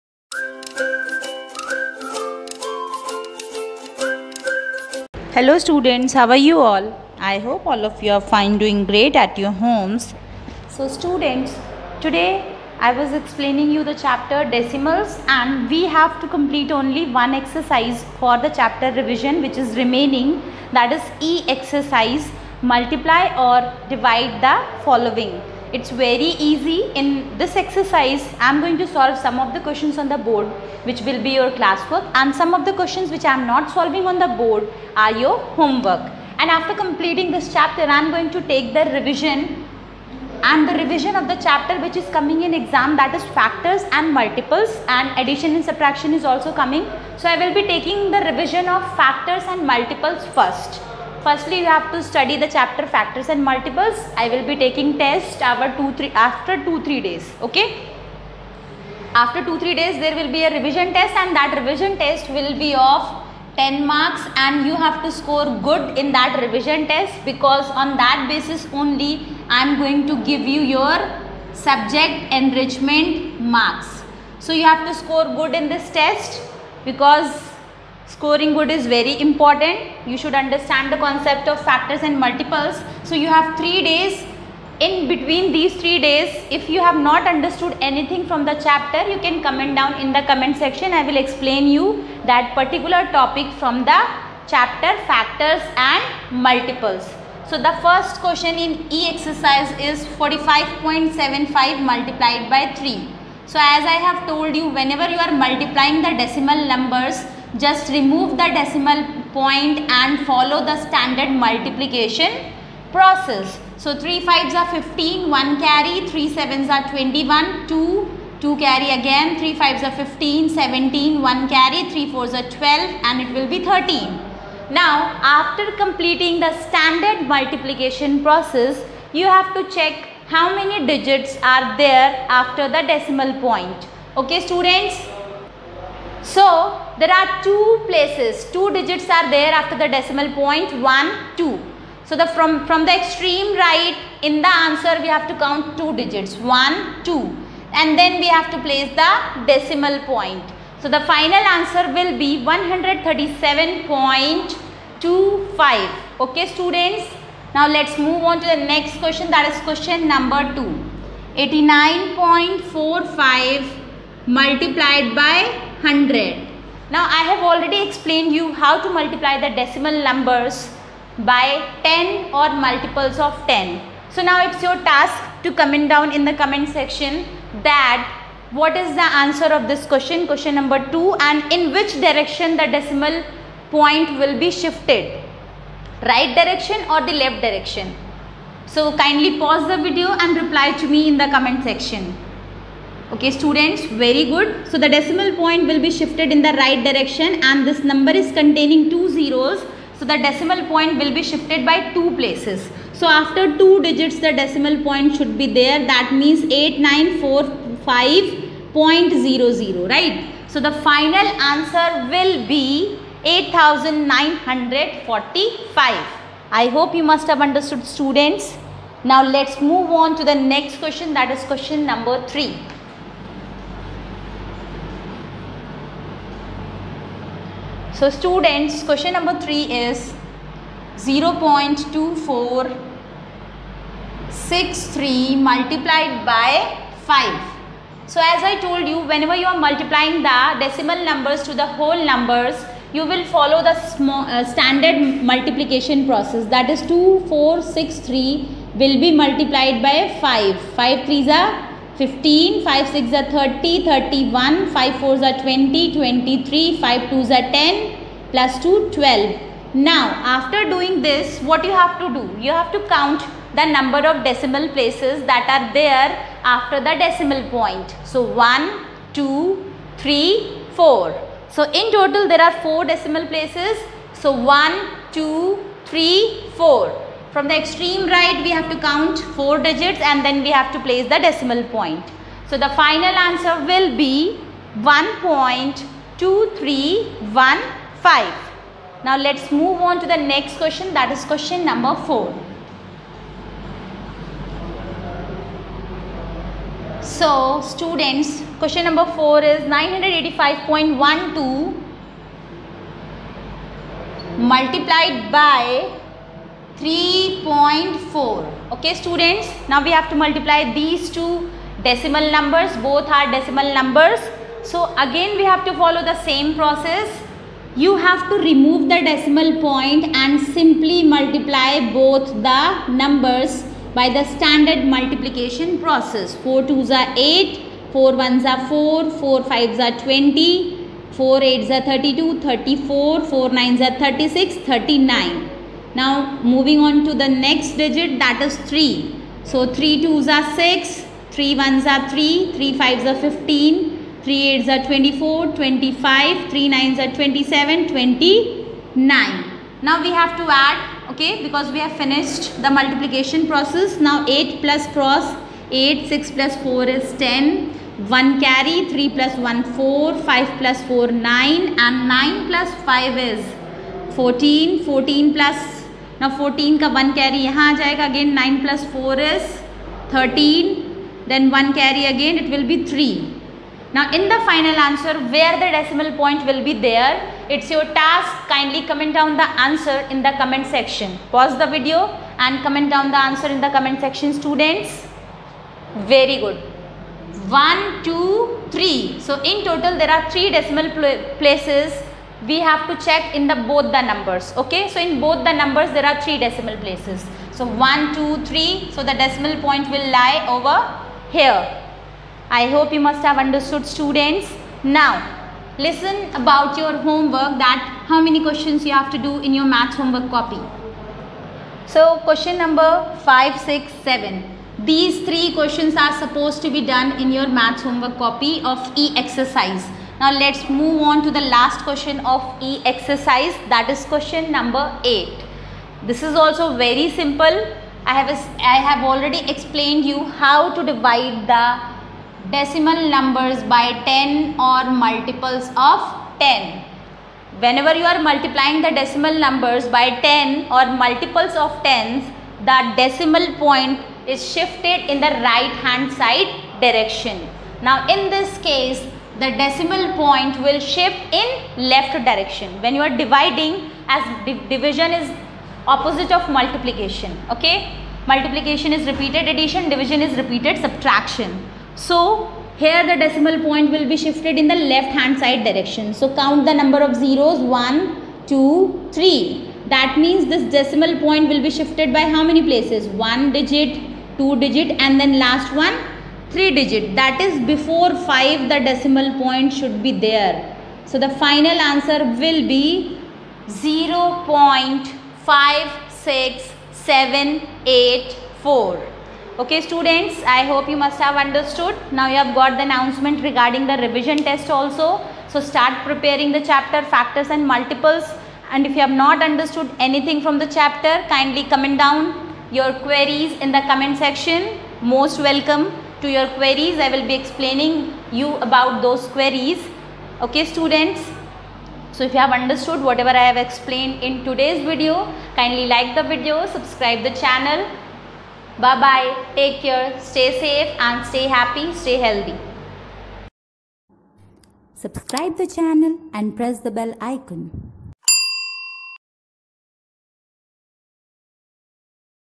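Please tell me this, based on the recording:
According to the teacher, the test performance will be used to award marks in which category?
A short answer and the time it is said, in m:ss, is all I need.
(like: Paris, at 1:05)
Subject enrichment, at 1:11.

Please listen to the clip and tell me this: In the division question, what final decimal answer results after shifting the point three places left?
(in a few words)
0.56784.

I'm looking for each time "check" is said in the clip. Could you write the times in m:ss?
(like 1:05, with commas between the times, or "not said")
2:09, 6:33.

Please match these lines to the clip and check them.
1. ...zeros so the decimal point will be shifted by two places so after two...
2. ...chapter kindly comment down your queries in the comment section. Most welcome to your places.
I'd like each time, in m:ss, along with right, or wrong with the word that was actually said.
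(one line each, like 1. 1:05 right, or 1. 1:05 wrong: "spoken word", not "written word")
1. 3:19 right
2. 8:20 wrong: "queries", not "places".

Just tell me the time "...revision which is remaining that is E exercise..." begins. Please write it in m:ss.
0:18.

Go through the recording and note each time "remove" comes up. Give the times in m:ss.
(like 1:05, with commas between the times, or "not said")
1:47, 5:18.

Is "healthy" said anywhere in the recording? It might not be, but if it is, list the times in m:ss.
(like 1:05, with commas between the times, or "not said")
8:42.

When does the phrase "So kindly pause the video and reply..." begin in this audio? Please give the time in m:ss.
3:08.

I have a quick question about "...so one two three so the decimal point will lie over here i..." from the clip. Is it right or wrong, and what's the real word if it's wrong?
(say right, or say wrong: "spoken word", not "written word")
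right.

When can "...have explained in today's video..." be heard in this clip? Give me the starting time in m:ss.
8:33.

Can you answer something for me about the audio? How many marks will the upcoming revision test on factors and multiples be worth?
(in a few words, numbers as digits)
10.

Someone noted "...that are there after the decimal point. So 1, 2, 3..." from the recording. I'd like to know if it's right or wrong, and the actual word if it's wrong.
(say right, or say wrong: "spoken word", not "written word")
right.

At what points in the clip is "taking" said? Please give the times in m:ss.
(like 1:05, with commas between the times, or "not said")
0:47, 0:54.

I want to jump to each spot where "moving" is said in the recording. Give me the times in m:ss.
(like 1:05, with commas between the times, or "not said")
5:36.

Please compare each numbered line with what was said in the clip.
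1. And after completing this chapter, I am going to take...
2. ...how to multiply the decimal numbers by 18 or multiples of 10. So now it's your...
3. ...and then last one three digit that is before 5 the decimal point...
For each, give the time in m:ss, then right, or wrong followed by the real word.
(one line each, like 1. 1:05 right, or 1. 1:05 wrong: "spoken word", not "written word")
1. 0:36 right
2. 2:48 wrong: "10", not "18"
3. 7:55 right.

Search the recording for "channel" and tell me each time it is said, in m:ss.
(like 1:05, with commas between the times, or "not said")
8:37, 8:45.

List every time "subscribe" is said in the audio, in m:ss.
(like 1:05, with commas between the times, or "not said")
8:36, 8:44.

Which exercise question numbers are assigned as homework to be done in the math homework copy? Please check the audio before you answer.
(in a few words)
5, 6, 7.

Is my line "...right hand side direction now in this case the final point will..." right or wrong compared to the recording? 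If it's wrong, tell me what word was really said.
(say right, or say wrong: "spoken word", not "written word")
wrong: "decimal", not "final".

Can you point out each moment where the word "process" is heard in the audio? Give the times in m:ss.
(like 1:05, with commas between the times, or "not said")
1:52, 2:08, 4:06, 5:16, 5:25, 5:53.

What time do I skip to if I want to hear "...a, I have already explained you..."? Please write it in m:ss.
7:08.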